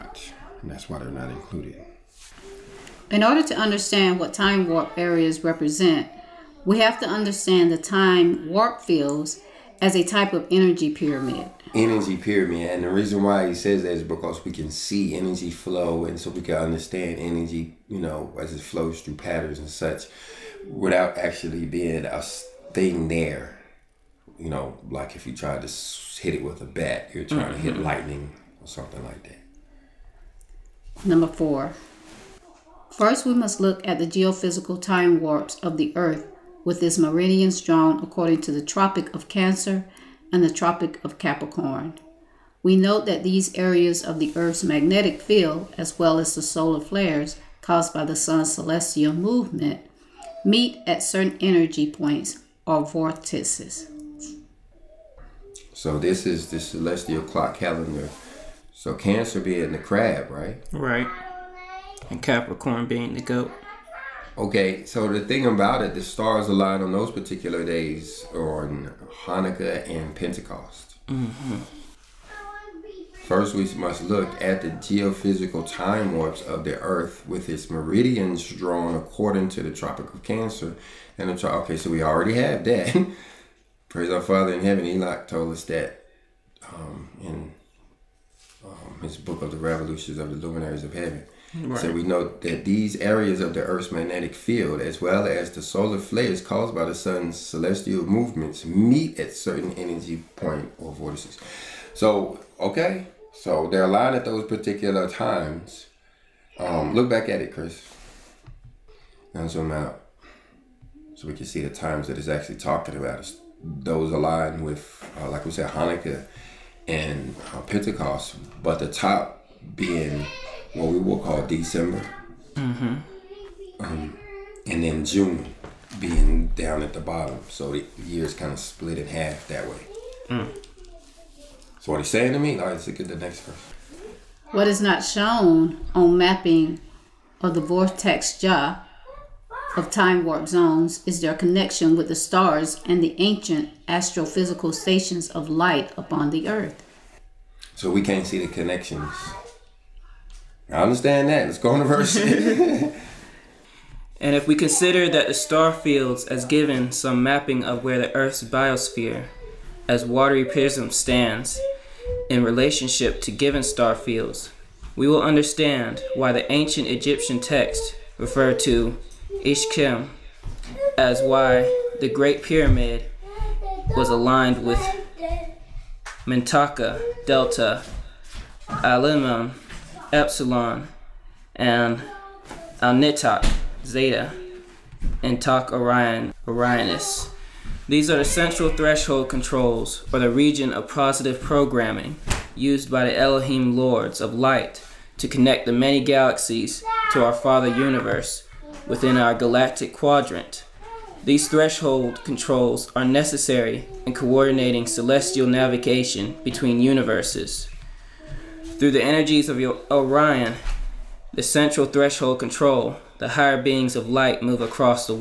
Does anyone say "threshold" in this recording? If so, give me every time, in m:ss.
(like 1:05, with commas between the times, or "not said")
3:08, 3:21, 3:31.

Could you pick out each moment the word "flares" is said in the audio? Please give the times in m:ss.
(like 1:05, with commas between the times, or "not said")
0:46, 1:35.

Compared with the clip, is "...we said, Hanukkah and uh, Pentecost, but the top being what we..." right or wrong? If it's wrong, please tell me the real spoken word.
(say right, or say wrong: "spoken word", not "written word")
right.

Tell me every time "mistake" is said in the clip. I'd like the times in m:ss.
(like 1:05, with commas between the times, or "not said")
not said.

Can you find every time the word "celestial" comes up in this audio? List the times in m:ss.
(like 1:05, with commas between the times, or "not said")
0:48, 0:56, 1:37, 3:24.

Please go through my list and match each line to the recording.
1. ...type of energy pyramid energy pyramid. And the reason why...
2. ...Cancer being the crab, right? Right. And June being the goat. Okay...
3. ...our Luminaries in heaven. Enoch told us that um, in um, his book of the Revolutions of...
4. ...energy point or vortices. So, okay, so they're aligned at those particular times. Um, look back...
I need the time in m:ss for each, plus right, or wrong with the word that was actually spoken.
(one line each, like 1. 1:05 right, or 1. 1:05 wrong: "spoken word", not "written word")
1. 0:10 right
2. 0:58 wrong: "Capricorn", not "June"
3. 1:24 wrong: "Father", not "Luminaries"
4. 1:39 right.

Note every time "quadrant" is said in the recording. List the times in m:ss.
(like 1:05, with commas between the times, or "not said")
3:19.